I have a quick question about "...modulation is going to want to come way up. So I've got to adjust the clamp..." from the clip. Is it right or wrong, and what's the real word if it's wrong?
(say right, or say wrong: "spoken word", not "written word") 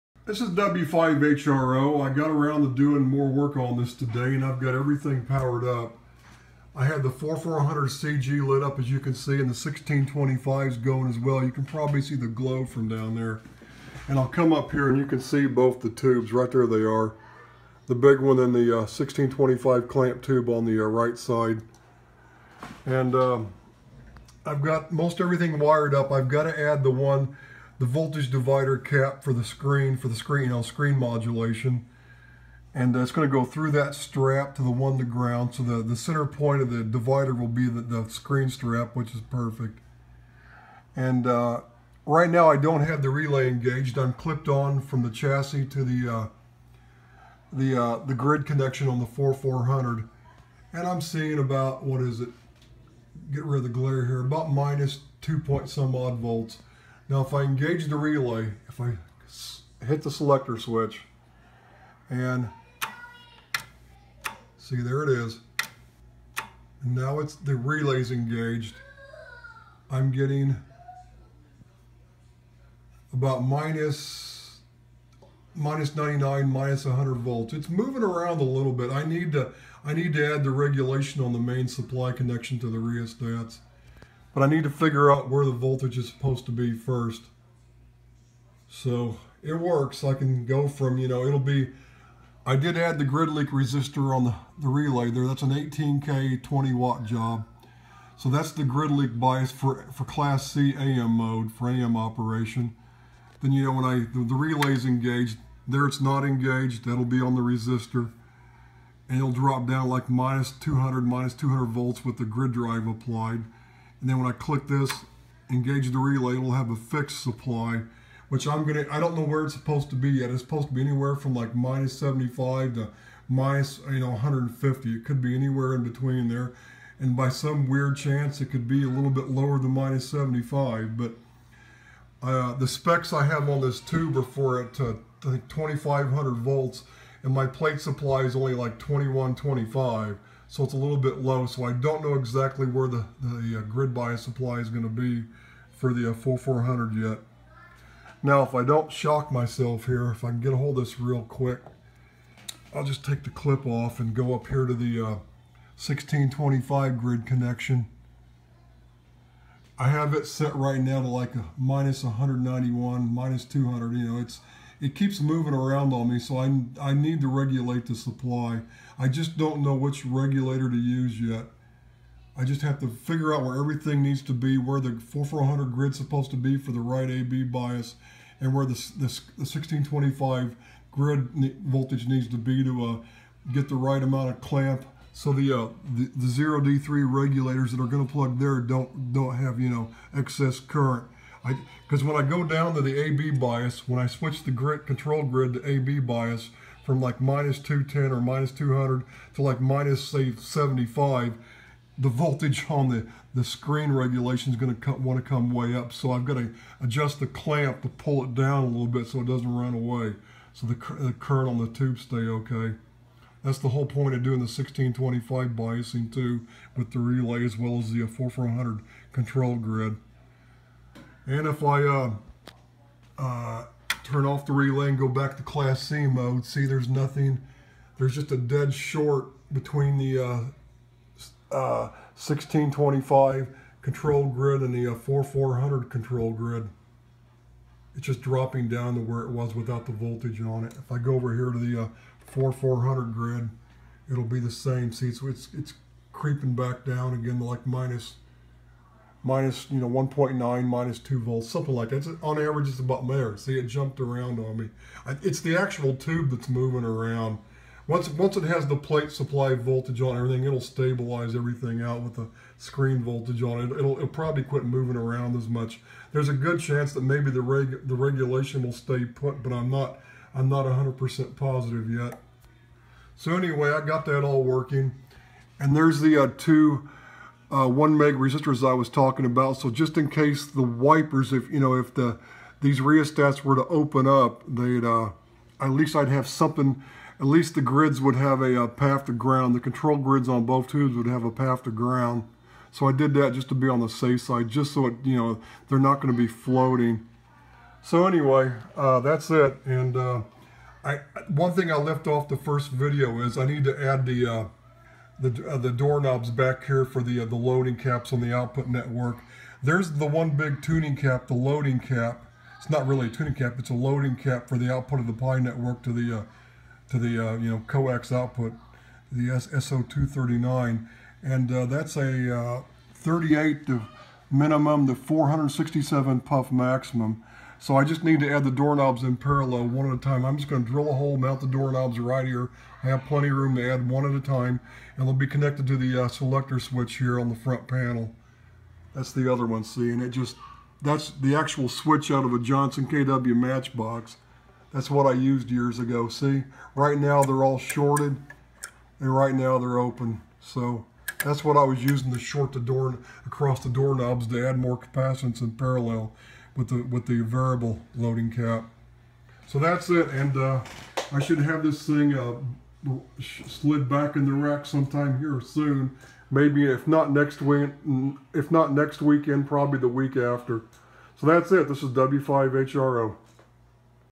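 wrong: "regulation", not "modulation".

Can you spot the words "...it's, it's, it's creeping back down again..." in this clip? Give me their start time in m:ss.
4:05.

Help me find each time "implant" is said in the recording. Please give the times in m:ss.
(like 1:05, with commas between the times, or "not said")
not said.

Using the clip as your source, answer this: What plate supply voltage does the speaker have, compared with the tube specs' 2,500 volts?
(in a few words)
2125.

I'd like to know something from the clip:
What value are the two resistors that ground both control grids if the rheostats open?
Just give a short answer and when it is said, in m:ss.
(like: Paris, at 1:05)
1 meg, at 4:37.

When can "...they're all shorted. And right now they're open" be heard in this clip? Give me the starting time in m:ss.
5:47.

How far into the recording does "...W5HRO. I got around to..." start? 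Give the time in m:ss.
0:00.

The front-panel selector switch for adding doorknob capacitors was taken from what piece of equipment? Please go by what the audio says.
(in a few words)
Johnson KW matchbox.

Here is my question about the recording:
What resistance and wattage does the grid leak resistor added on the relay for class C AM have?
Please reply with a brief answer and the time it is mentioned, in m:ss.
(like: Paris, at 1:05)
18K 20 watt, at 1:35.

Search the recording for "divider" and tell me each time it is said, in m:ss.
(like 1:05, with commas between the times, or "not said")
0:28, 0:36.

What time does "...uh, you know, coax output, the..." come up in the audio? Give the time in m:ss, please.
5:17.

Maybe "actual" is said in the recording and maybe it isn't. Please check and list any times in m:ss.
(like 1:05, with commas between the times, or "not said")
4:15, 5:41.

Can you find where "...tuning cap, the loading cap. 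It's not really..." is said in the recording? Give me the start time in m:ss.
5:10.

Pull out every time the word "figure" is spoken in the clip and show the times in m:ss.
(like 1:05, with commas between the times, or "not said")
1:24, 2:52.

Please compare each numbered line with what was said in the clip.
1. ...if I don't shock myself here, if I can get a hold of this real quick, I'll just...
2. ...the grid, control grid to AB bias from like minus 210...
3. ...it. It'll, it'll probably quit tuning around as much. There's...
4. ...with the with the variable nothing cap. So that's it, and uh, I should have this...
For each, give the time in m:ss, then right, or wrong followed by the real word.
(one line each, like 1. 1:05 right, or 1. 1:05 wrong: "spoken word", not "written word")
1. 2:28 right
2. 3:14 right
3. 4:23 wrong: "moving", not "tuning"
4. 5:56 wrong: "loading", not "nothing".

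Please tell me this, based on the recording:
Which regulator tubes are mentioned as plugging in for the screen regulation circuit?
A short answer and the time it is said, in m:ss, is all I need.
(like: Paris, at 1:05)
0D3, at 3:06.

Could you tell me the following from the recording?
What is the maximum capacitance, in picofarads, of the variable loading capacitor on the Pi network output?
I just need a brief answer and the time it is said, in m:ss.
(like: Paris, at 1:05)
467, at 5:24.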